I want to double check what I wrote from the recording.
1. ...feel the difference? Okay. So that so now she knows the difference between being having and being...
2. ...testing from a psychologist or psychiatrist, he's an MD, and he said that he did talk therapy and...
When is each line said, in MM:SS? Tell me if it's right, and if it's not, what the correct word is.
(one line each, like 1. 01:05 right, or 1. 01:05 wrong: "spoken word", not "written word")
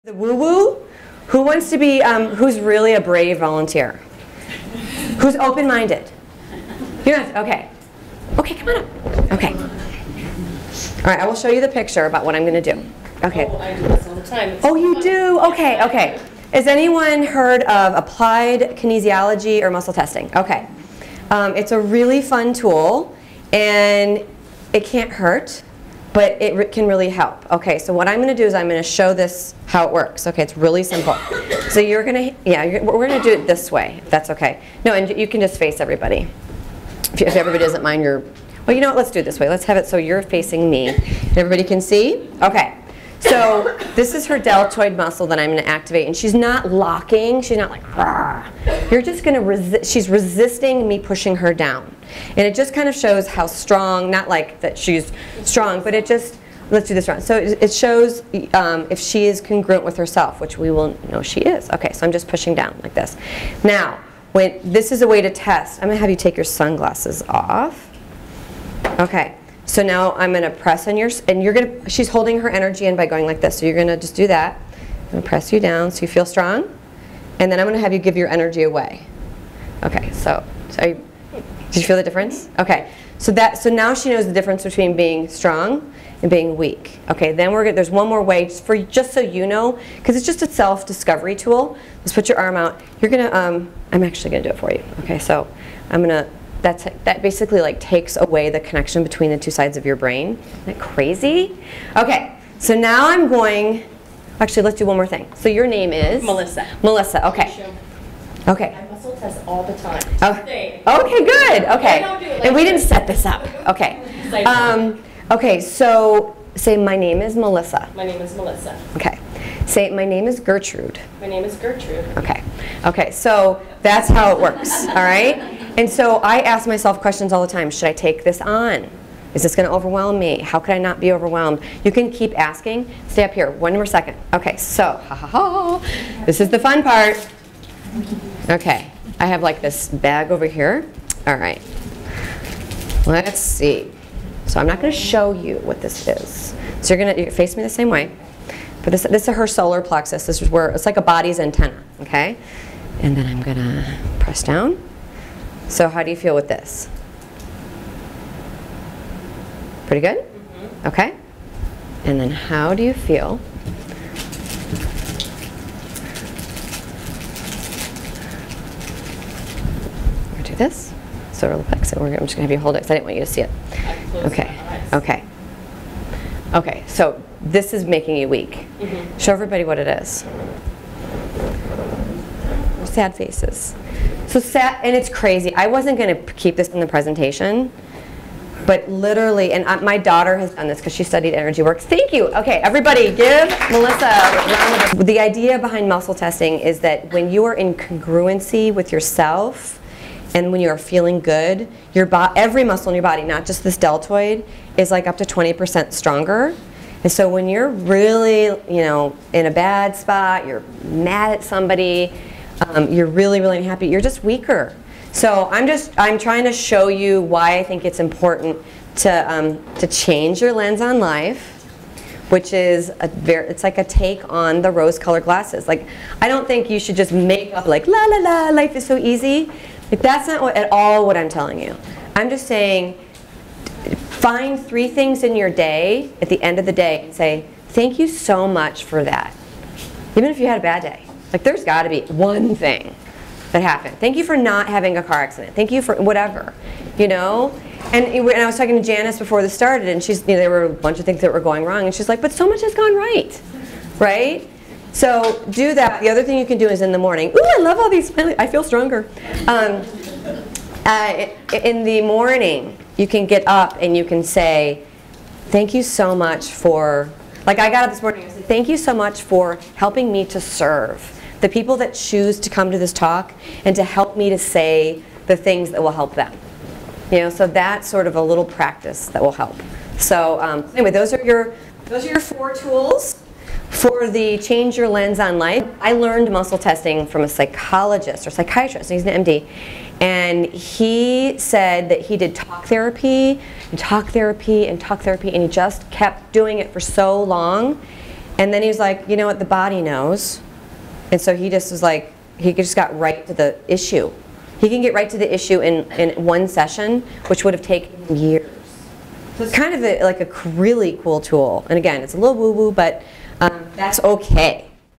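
1. 01:21 wrong: "strong", not "having"
2. 04:46 right.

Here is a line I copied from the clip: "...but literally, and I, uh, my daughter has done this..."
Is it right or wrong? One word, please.
right.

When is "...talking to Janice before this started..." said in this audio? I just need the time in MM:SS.
04:08.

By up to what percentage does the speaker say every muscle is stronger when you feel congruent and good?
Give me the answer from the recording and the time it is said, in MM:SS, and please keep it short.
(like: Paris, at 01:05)
20%, at 03:25.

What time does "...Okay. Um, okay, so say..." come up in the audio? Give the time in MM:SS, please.
01:53.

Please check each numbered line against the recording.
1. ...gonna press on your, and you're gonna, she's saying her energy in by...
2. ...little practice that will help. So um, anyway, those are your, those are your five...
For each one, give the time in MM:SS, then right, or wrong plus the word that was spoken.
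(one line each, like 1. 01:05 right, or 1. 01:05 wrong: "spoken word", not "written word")
1. 01:10 wrong: "holding", not "saying"
2. 04:38 wrong: "four", not "five".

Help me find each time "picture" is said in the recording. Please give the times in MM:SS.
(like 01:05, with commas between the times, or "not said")
00:11.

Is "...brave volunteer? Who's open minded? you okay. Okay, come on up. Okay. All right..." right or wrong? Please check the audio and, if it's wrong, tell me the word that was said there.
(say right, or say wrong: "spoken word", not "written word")
right.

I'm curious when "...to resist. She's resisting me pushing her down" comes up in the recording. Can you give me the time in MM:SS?
00:49.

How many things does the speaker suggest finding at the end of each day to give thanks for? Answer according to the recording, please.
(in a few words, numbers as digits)
3.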